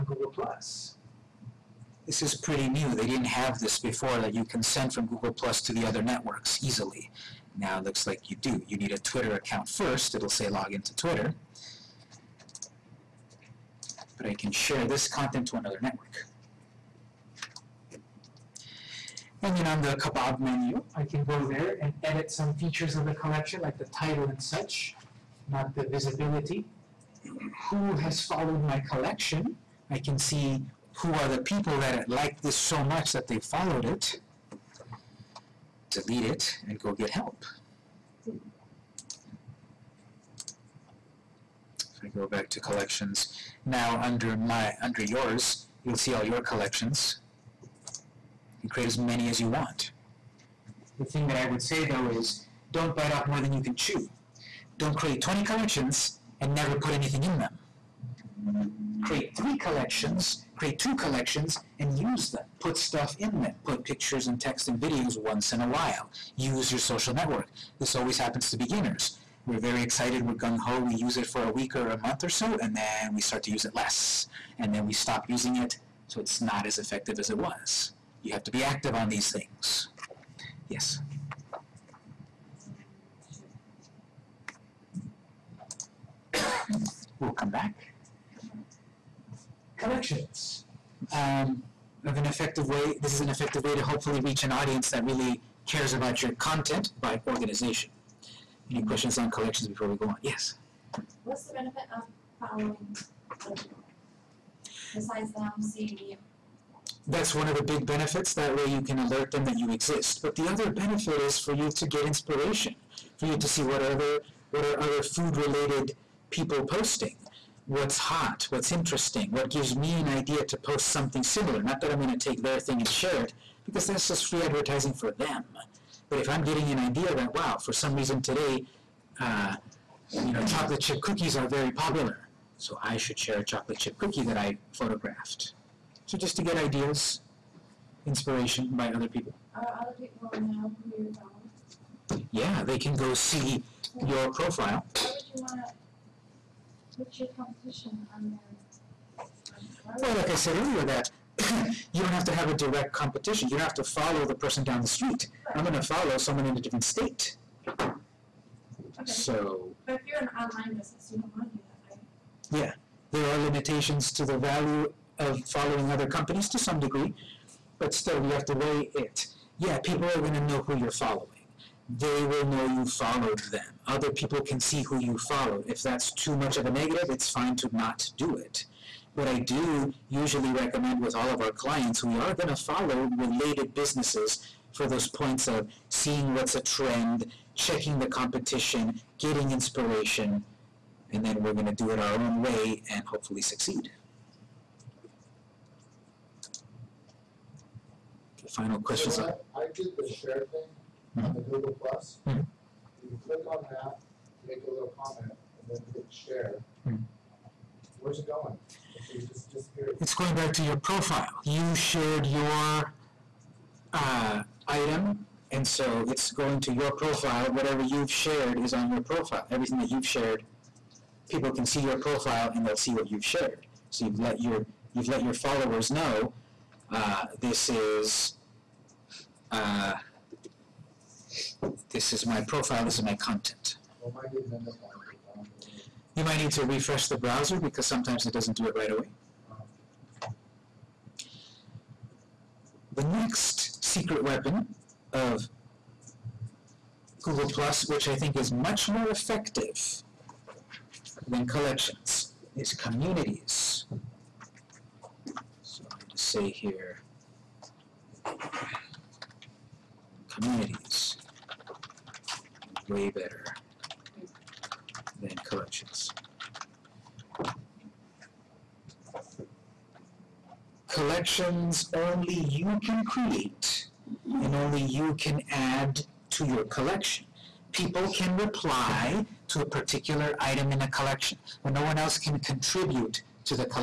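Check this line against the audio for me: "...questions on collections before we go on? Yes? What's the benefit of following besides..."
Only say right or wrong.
right.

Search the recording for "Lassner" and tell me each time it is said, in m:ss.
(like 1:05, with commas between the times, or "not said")
not said.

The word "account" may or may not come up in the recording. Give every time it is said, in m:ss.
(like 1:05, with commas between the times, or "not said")
0:09.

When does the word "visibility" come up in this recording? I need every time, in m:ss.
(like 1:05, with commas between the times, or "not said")
0:25.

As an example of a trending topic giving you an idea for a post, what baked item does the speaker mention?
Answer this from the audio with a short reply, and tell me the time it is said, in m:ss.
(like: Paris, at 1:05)
chocolate chip cookies, at 2:10.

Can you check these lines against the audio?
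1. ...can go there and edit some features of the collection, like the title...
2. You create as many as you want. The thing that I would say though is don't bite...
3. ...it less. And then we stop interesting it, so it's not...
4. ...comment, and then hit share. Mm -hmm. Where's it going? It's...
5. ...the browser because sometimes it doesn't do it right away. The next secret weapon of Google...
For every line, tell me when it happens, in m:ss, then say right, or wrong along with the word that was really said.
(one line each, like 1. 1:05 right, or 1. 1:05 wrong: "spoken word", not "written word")
1. 0:21 right
2. 0:48 right
3. 1:13 wrong: "using", not "interesting"
4. 3:25 right
5. 3:57 right.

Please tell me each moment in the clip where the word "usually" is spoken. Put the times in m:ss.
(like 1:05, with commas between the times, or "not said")
3:00.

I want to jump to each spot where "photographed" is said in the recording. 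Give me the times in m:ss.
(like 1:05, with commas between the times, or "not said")
2:14.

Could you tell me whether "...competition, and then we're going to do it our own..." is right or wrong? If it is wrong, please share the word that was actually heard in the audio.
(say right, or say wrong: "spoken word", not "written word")
wrong: "inspiration", not "competition".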